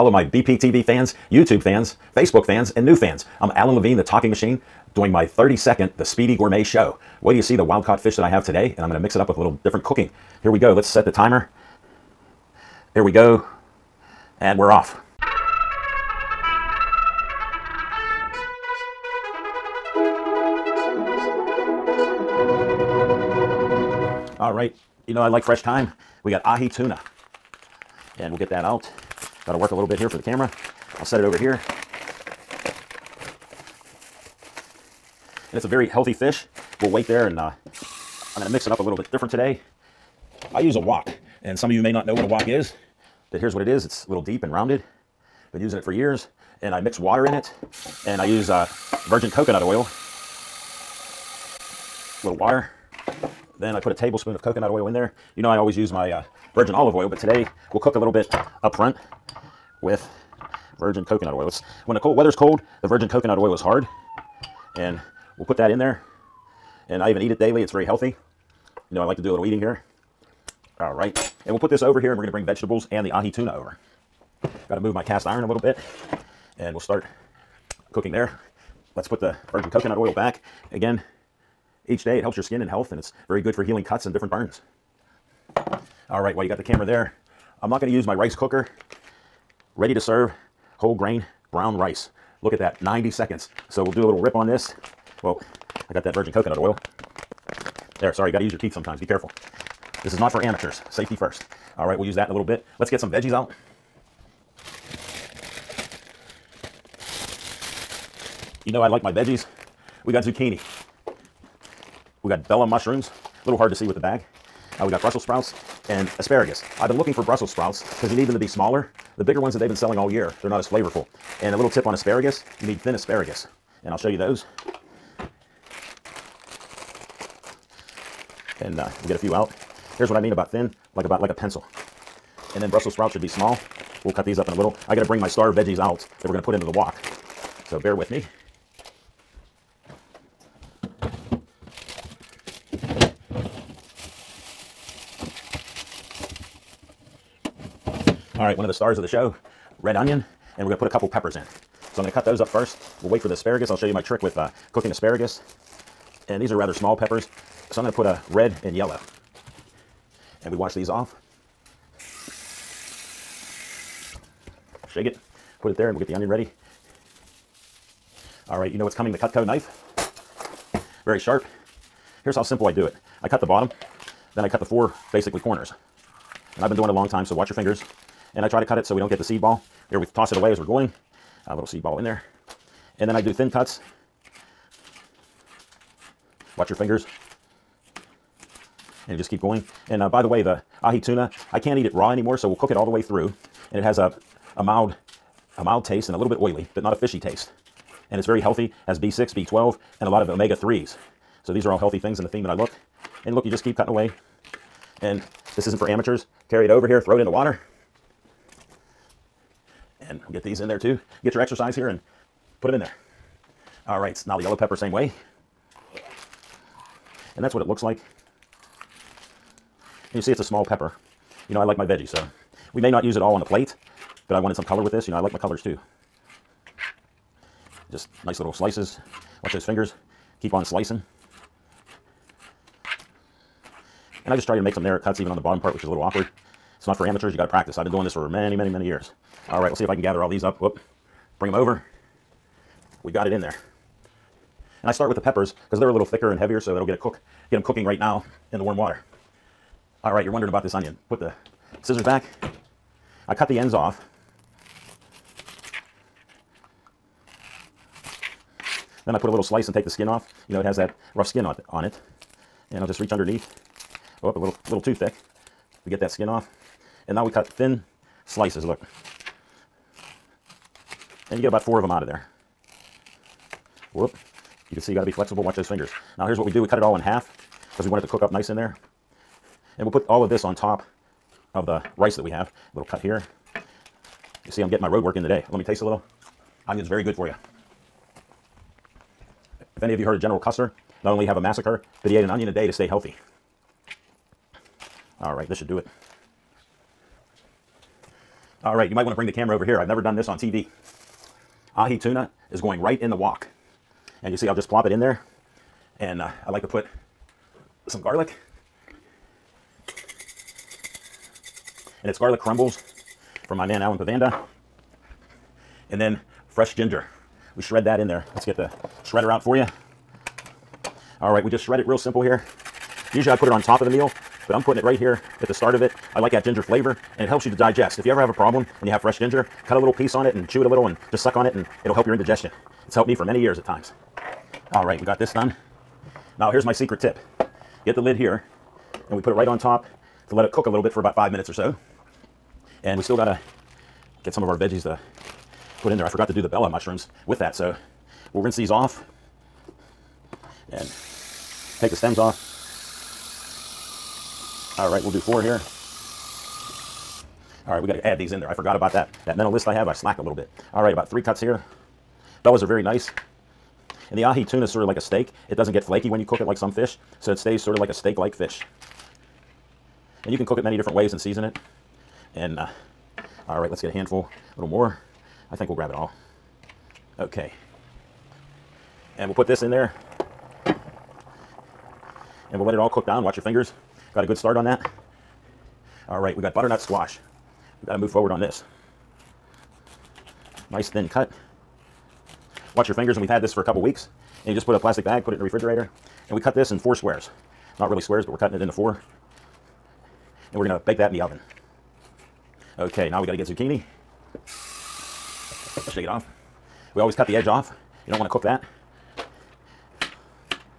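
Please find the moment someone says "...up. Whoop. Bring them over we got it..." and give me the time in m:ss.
4:00.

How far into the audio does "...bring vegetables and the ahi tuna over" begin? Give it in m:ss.
1:12.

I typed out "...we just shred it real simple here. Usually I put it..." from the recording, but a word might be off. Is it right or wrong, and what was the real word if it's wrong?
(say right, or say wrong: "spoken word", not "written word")
right.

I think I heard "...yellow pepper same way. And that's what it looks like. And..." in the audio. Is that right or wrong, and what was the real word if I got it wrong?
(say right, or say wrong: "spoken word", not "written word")
right.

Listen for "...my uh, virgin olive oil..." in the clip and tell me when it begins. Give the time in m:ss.
0:55.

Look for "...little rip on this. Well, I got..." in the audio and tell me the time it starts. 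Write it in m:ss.
1:34.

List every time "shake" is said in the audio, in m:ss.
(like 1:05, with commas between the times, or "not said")
2:44, 6:45.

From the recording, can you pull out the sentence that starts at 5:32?
It's helped me for many years at times.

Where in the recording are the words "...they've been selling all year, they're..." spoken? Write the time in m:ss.
1:59.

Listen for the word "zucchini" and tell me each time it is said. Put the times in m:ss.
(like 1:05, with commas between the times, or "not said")
1:50, 6:43.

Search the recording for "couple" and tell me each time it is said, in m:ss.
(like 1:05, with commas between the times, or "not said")
2:30, 6:33.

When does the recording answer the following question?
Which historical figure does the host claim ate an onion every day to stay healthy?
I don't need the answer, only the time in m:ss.
4:50.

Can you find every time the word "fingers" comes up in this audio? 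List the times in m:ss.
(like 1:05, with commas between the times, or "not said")
2:57, 3:06, 3:49, 4:35, 6:23, 6:32.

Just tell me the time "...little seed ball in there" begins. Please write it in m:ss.
3:01.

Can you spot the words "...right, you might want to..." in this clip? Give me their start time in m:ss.
4:58.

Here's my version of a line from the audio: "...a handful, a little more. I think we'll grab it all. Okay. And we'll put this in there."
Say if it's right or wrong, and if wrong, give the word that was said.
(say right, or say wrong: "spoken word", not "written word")
right.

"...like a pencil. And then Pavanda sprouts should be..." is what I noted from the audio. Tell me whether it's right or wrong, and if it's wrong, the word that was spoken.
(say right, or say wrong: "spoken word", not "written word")
wrong: "Brussels", not "Pavanda".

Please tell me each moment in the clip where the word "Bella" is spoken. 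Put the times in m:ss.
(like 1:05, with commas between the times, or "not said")
1:52, 5:46, 6:02.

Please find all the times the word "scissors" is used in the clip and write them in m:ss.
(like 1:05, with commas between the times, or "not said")
4:11.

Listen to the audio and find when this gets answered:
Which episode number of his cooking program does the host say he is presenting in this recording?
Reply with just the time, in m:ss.
0:05.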